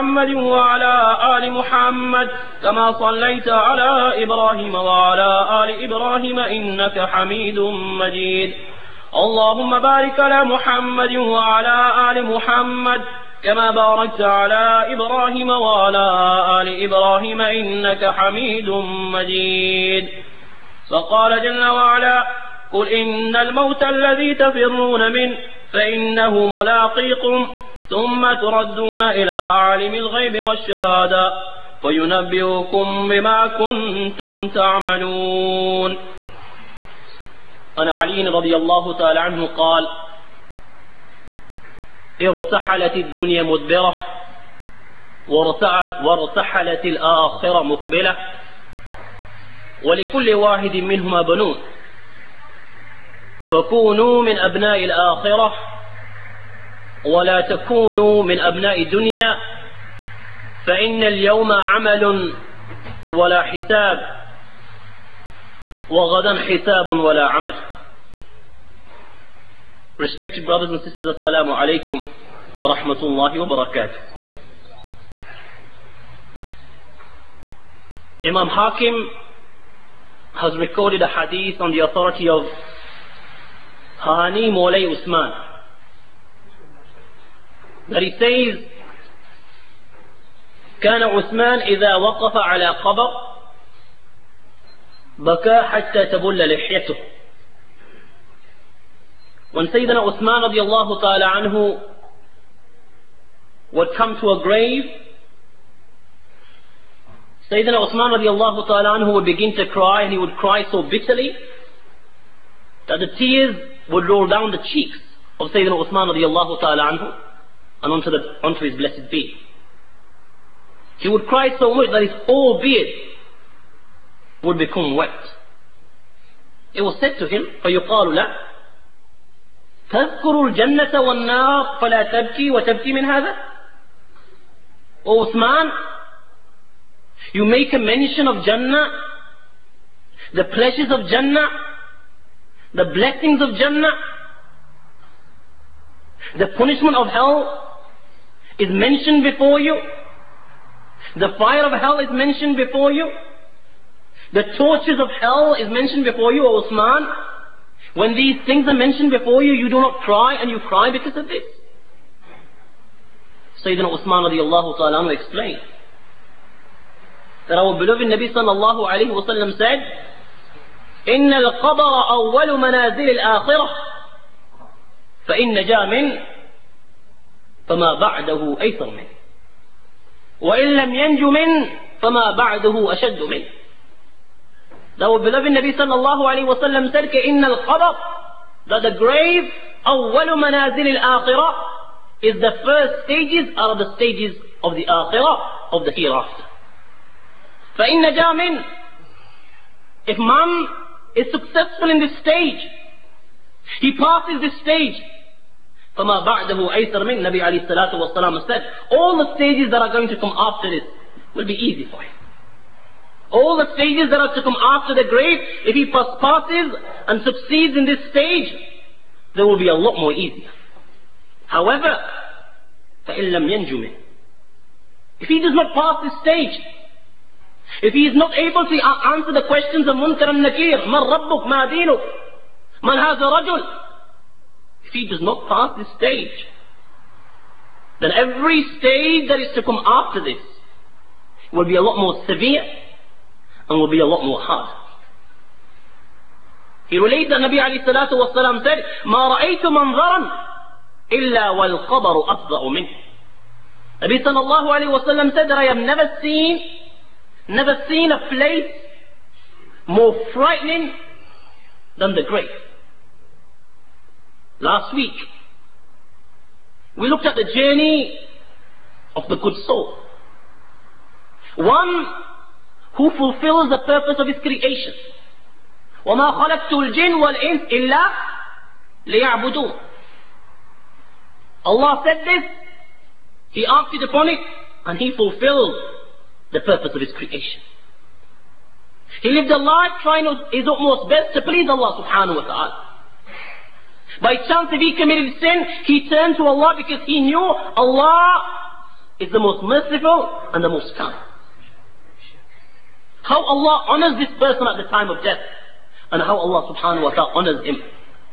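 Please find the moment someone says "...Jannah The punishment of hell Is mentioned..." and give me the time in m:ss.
2:23.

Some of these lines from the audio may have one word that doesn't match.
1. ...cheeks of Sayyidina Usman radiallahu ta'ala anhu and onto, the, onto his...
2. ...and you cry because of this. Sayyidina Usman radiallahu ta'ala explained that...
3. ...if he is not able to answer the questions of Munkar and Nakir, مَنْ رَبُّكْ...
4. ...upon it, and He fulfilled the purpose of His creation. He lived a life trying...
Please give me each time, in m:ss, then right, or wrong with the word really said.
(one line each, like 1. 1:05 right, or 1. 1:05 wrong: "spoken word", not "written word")
1. 1:54 right
2. 2:40 right
3. 3:47 right
4. 4:44 right.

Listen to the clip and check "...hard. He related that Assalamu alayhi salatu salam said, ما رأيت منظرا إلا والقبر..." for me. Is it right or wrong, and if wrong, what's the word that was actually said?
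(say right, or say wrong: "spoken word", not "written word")
wrong: "Nabi", not "Assalamu".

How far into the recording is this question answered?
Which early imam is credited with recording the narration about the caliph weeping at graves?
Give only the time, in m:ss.
1:18.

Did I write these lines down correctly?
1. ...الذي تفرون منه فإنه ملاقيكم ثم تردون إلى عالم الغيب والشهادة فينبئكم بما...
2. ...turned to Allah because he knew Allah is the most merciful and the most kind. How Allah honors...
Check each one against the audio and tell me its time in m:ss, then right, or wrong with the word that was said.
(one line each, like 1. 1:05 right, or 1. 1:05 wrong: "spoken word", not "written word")
1. 0:23 right
2. 4:56 right.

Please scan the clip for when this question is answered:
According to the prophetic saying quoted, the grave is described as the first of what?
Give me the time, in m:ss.
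3:13.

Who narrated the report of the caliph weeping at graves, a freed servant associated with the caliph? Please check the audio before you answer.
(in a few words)
Hani Mawlay Usman.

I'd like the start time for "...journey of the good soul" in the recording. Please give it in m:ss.
4:27.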